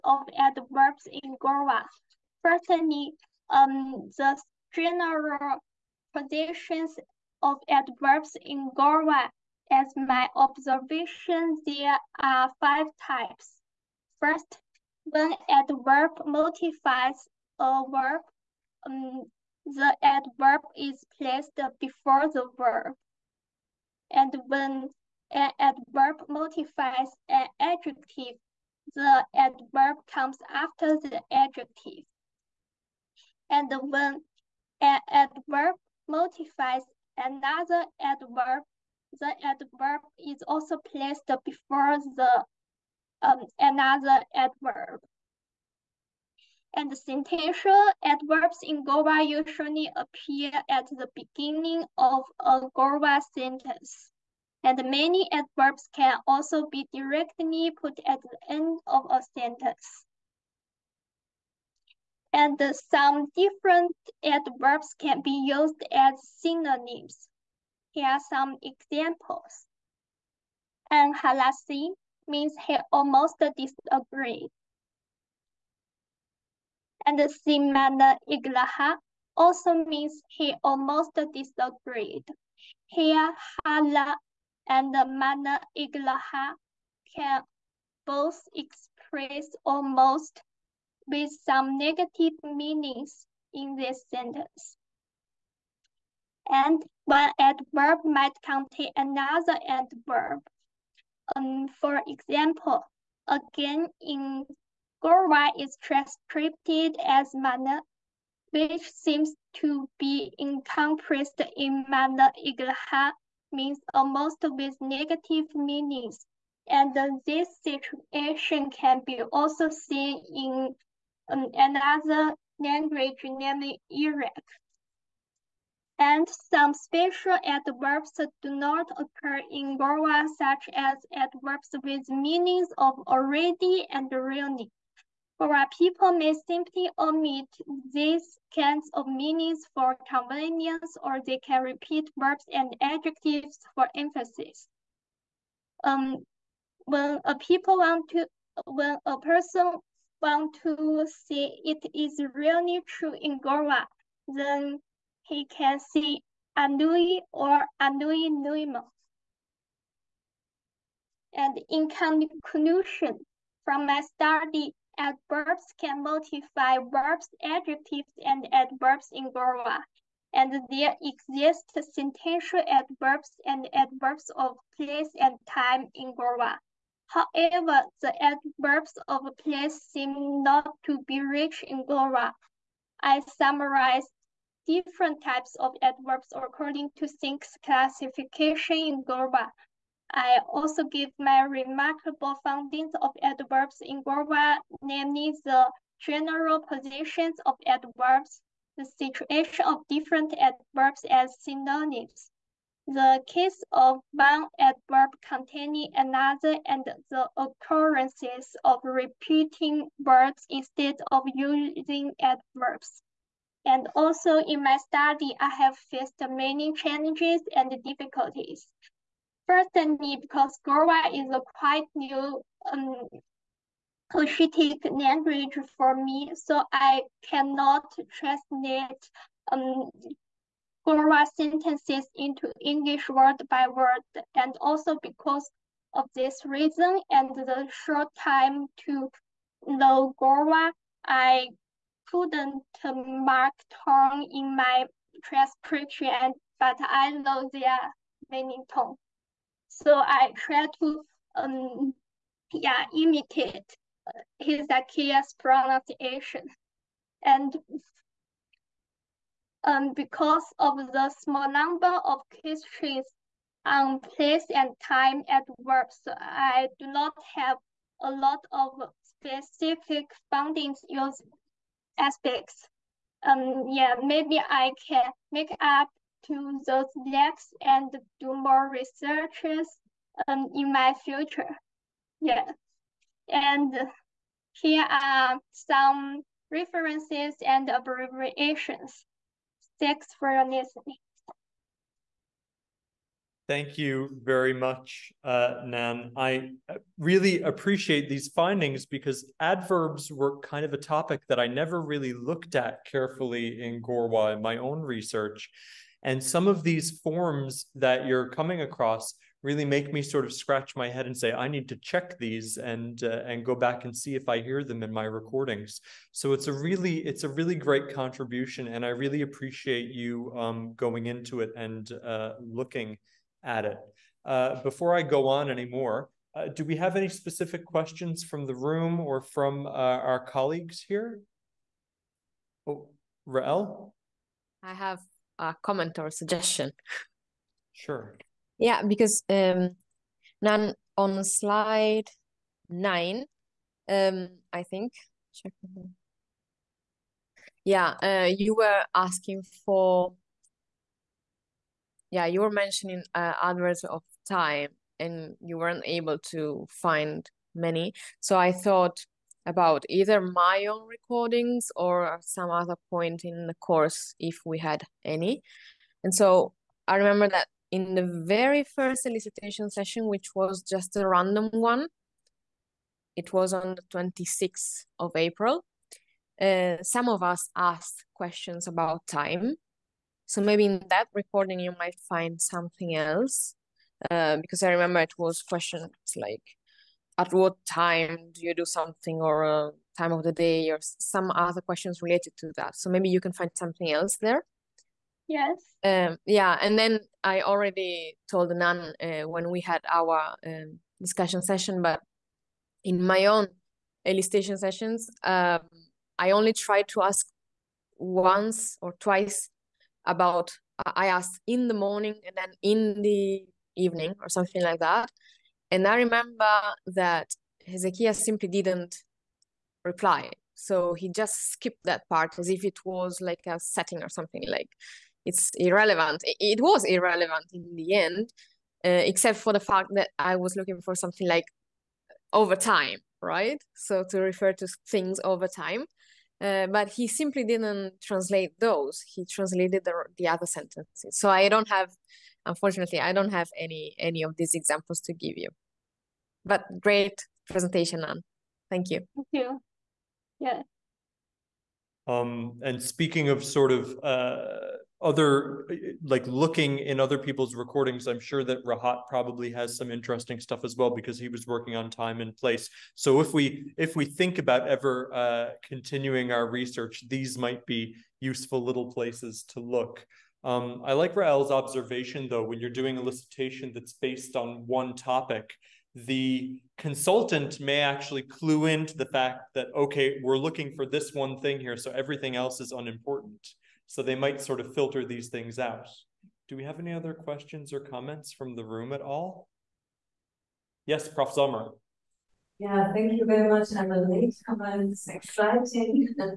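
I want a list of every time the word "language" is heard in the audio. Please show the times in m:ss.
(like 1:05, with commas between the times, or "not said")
2:02, 3:44.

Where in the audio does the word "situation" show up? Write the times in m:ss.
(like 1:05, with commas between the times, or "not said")
1:57, 3:18.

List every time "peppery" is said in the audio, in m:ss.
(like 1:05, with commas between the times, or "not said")
not said.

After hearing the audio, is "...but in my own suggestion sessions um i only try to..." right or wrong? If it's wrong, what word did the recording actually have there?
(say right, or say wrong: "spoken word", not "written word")
wrong: "elicitation", not "suggestion".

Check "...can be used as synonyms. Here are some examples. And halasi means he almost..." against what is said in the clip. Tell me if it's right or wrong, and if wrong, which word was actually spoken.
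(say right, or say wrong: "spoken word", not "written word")
right.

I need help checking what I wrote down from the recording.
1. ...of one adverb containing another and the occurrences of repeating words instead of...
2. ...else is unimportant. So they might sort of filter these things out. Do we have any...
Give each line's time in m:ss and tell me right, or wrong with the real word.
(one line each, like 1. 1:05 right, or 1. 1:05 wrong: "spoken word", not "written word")
1. 3:23 right
2. 8:02 right.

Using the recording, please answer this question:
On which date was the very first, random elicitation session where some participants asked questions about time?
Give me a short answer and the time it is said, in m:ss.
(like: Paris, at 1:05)
26 April, at 6:13.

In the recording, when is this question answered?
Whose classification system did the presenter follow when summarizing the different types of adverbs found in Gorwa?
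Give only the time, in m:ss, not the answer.
3:07.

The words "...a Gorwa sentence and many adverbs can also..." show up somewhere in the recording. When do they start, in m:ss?
0:52.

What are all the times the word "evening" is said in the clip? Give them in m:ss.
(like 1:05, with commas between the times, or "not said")
6:53.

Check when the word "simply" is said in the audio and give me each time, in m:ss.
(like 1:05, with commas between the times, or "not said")
2:16, 6:58, 7:17.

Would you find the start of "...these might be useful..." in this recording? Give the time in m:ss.
7:47.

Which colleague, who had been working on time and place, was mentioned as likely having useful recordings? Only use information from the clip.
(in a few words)
Rahat.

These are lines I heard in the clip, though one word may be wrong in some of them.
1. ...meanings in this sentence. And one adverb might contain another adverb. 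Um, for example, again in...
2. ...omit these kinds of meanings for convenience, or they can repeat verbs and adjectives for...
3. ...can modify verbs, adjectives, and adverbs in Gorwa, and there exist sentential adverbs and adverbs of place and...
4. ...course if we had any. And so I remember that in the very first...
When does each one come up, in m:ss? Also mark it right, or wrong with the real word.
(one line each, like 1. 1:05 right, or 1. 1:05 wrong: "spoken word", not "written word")
1. 1:32 right
2. 2:16 right
3. 2:45 right
4. 6:03 right.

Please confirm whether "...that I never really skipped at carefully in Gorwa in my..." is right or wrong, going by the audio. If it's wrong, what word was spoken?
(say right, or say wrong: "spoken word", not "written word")
wrong: "looked", not "skipped".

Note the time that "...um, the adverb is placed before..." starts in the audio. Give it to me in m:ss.
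0:18.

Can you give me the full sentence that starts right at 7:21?
So I don't have Unfortunately, I don't have any any of these examples to give you.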